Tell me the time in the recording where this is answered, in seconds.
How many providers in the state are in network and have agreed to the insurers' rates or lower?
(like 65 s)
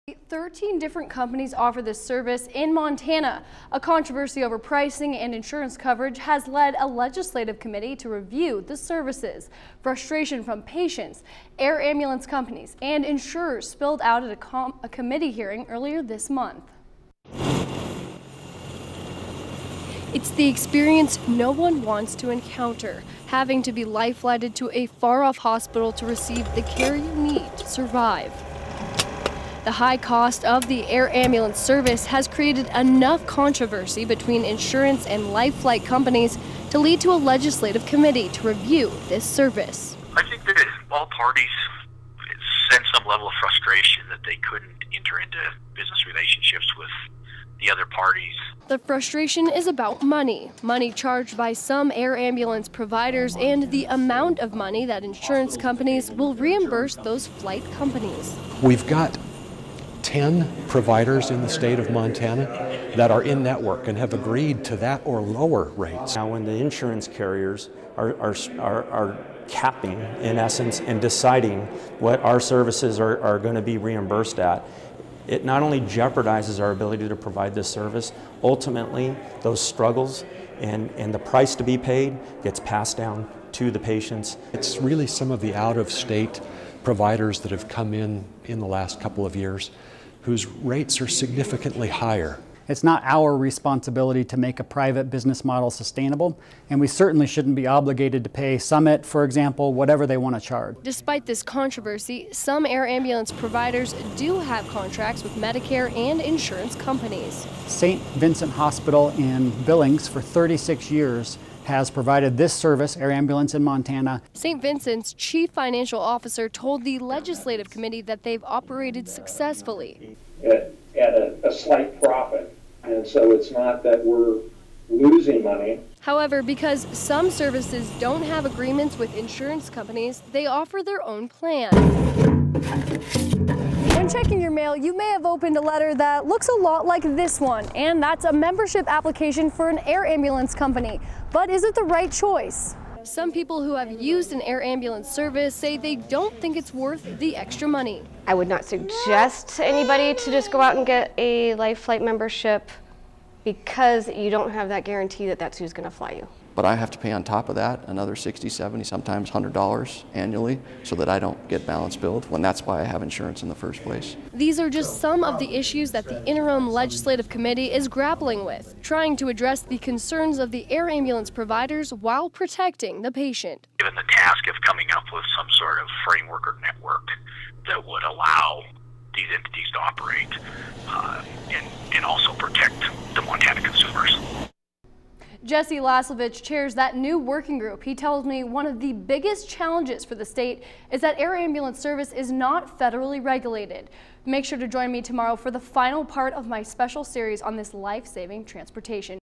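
60 s.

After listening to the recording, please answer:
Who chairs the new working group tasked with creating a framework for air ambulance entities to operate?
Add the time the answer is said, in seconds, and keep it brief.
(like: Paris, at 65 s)
Jesse Laslovich, at 185 s.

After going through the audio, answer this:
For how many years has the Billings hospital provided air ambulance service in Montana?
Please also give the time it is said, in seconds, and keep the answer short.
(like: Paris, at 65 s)
36, at 110 s.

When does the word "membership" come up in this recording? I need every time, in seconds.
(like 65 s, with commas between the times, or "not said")
138 s, 152 s.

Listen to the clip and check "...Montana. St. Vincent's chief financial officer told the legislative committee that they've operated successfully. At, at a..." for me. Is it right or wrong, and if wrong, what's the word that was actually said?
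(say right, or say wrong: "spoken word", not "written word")
right.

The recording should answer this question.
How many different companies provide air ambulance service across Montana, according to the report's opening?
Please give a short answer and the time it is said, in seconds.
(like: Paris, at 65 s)
13, at 0 s.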